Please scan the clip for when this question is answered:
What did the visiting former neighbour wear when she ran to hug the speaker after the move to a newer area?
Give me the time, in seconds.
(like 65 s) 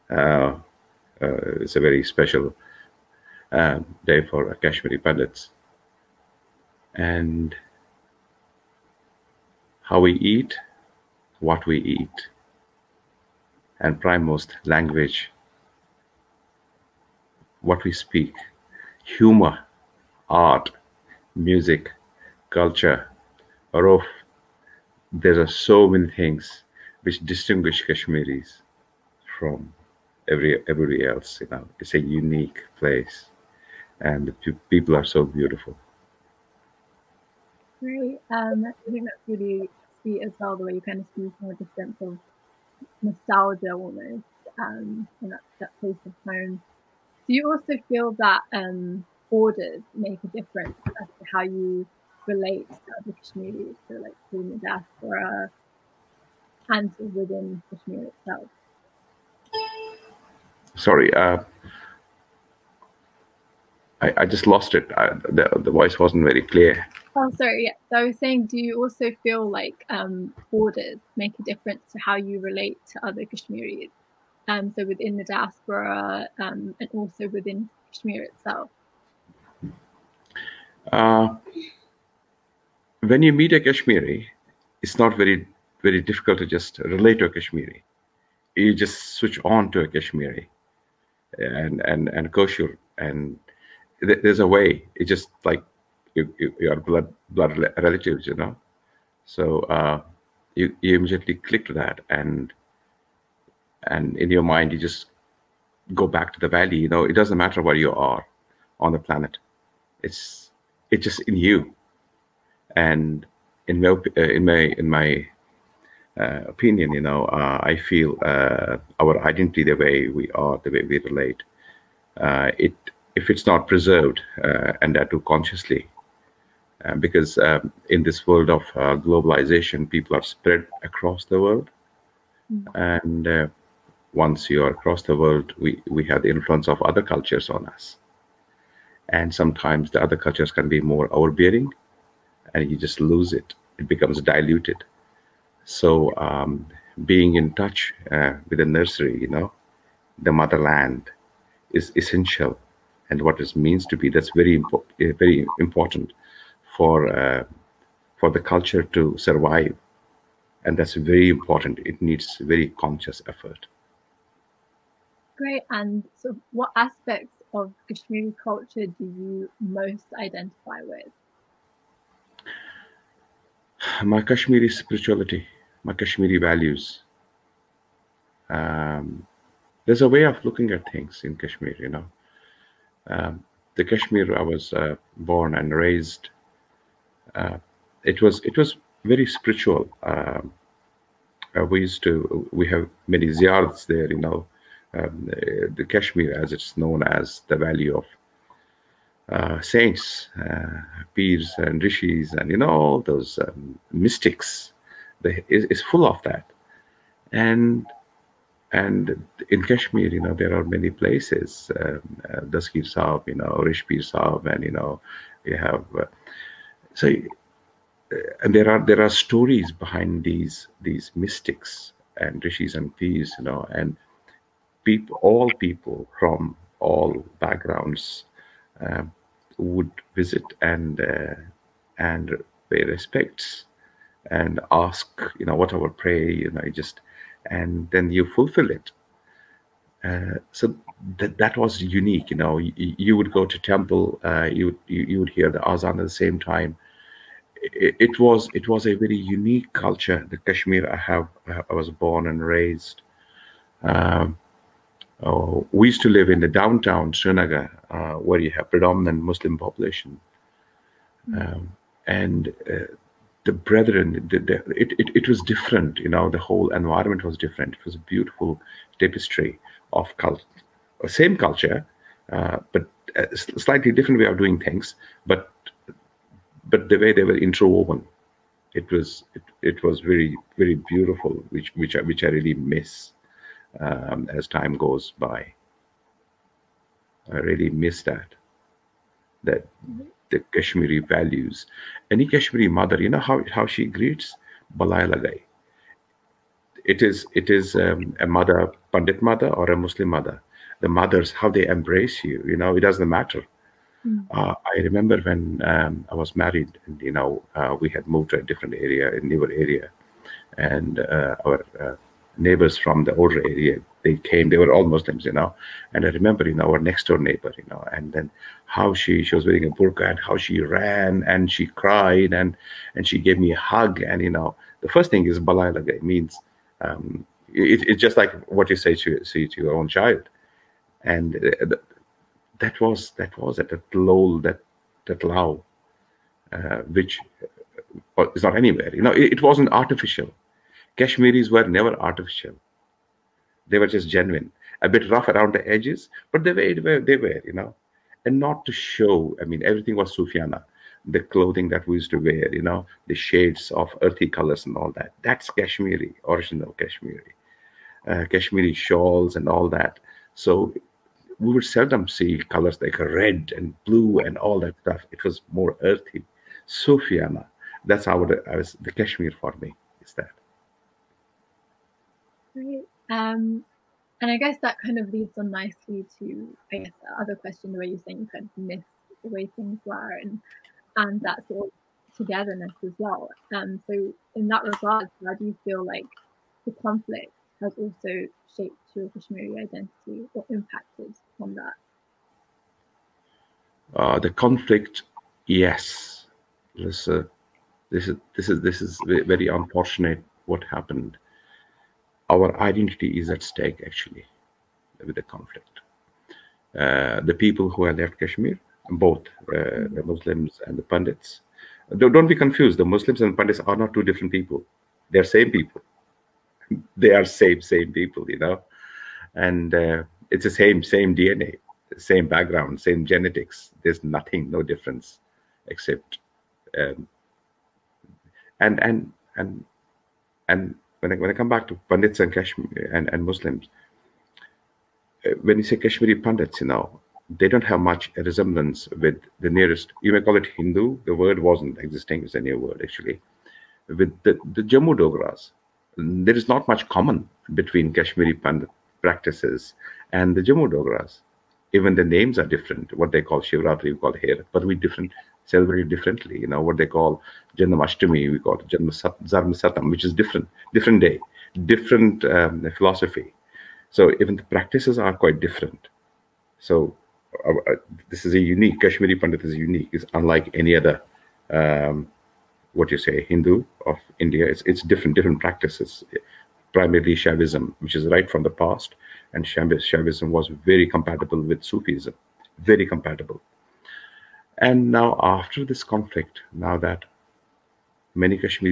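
319 s.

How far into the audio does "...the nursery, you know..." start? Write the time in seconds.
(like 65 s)
148 s.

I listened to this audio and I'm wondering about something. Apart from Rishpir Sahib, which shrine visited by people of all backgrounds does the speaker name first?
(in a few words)
Dastgeer Sahib.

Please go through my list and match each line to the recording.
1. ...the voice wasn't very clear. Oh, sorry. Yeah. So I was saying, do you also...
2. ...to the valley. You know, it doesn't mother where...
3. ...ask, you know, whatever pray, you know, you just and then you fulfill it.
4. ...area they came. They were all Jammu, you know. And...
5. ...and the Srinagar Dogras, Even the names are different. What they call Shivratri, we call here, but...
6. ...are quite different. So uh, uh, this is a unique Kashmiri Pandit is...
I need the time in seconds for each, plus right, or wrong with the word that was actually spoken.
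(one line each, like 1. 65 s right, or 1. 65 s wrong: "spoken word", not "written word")
1. 65 s right
2. 106 s wrong: "matter", not "mother"
3. 234 s right
4. 313 s wrong: "Muslims", not "Jammu"
5. 450 s wrong: "Jammu", not "Srinagar"
6. 465 s right.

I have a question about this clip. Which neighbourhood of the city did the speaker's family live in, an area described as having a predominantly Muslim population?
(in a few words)
downtown Srinagar.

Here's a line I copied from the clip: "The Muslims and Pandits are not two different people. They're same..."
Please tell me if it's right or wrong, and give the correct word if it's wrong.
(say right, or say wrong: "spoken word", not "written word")
right.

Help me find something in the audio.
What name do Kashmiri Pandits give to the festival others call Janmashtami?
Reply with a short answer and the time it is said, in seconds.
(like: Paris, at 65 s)
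Janmasatam, at 459 s.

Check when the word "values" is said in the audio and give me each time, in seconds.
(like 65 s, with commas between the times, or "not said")
176 s, 290 s.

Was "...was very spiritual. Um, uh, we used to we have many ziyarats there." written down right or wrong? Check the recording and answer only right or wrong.
right.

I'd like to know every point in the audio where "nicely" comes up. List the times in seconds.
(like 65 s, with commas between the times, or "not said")
375 s.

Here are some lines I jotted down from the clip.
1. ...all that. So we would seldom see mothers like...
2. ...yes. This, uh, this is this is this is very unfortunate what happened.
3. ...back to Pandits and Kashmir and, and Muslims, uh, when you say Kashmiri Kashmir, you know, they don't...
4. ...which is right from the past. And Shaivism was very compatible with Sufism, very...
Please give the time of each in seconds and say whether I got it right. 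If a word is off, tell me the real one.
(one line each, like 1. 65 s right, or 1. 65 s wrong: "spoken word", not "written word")
1. 359 s wrong: "colors", not "mothers"
2. 395 s right
3. 431 s wrong: "Pandits", not "Kashmir"
4. 477 s right.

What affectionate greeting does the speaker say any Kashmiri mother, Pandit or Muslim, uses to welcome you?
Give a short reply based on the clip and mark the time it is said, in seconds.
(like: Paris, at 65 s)
balai lagai, at 294 s.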